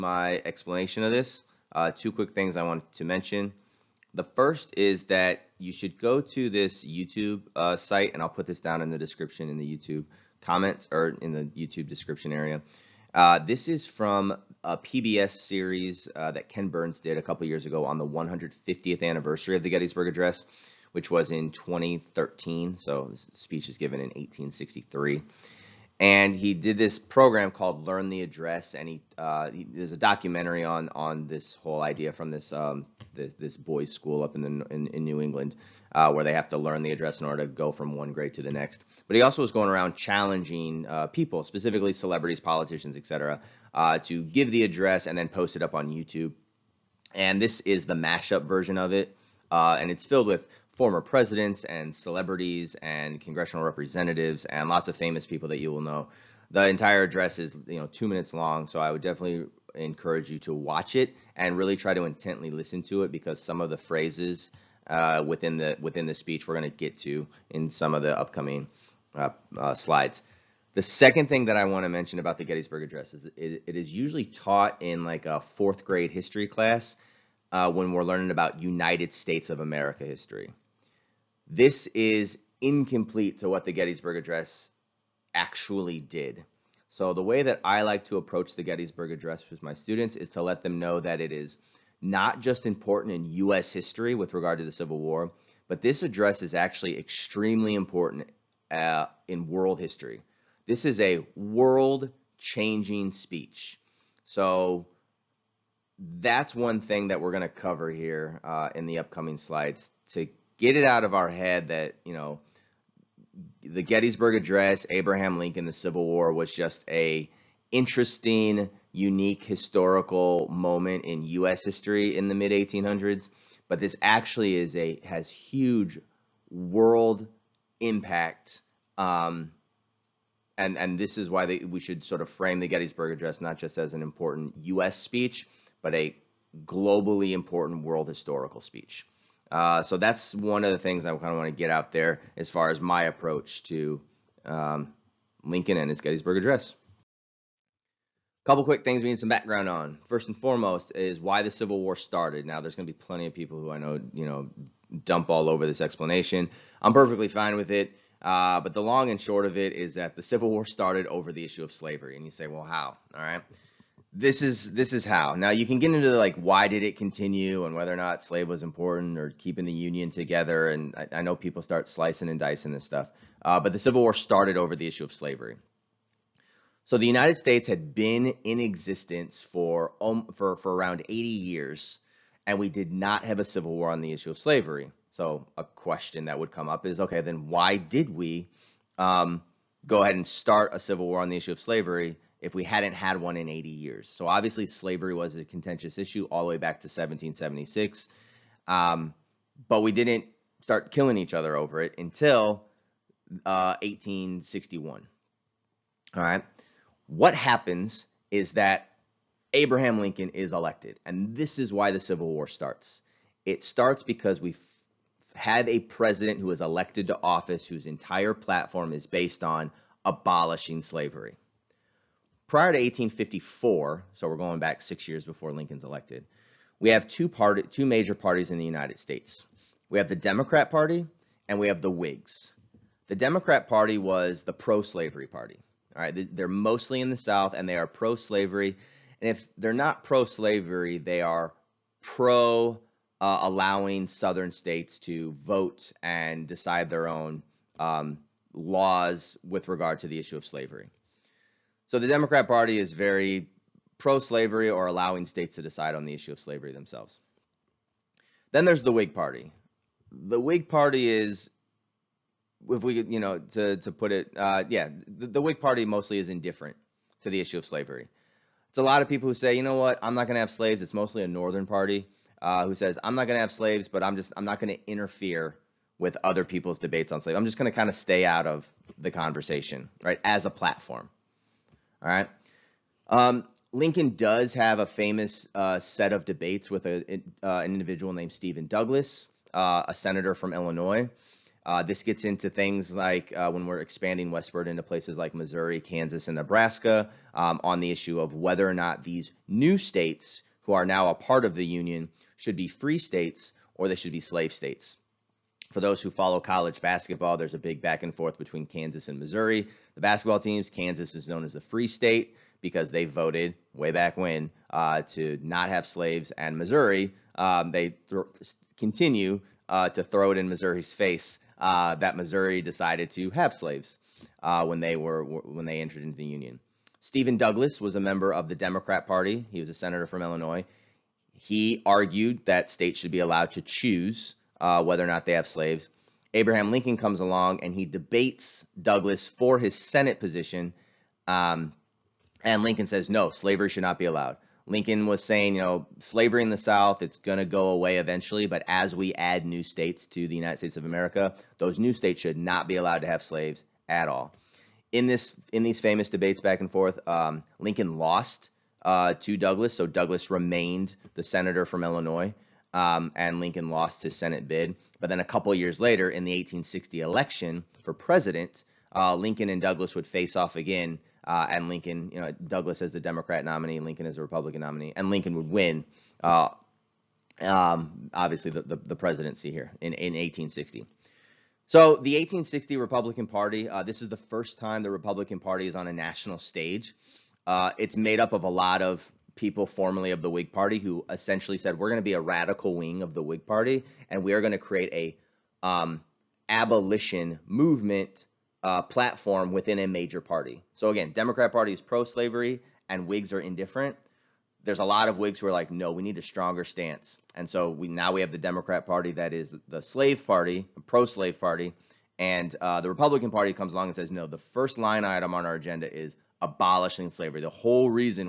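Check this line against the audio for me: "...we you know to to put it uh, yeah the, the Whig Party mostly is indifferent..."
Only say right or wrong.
right.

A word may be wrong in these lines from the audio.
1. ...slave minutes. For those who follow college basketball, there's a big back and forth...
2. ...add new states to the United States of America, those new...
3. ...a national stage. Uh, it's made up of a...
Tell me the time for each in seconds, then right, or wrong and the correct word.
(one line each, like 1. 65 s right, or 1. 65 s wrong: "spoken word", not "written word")
1. 304 s wrong: "states", not "minutes"
2. 349 s right
3. 385 s right.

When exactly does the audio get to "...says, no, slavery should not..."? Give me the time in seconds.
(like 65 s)
342 s.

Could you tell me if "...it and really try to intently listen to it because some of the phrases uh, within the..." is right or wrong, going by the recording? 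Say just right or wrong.
right.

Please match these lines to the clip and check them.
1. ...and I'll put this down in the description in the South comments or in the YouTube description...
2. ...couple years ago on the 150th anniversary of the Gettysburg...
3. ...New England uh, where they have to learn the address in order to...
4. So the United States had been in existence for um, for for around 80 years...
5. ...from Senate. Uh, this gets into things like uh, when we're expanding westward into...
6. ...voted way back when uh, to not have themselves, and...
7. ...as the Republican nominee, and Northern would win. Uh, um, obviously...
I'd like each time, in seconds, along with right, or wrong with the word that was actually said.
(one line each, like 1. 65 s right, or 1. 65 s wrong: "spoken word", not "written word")
1. 8 s wrong: "YouTube", not "South"
2. 17 s right
3. 35 s right
4. 176 s right
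5. 290 s wrong: "Illinois", not "Senate"
6. 313 s wrong: "slaves", not "themselves"
7. 374 s wrong: "Lincoln", not "Northern".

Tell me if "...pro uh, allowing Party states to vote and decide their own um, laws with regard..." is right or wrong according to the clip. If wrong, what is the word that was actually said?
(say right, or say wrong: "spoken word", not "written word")
wrong: "Southern", not "Party".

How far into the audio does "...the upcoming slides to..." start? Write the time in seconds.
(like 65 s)
108 s.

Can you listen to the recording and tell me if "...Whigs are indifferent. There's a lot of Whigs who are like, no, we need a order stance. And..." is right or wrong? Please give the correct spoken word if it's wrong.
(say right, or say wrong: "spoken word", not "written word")
wrong: "stronger", not "order".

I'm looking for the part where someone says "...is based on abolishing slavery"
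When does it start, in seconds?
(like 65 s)
218 s.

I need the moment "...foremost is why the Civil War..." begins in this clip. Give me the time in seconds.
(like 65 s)
150 s.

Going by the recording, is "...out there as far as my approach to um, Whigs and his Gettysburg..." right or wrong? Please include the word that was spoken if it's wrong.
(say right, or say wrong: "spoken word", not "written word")
wrong: "Lincoln", not "Whigs".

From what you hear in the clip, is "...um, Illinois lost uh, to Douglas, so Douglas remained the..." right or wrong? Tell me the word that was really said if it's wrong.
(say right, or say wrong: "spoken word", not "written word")
wrong: "Lincoln", not "Illinois".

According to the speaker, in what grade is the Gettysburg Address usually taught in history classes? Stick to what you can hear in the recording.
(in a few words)
fourth grade.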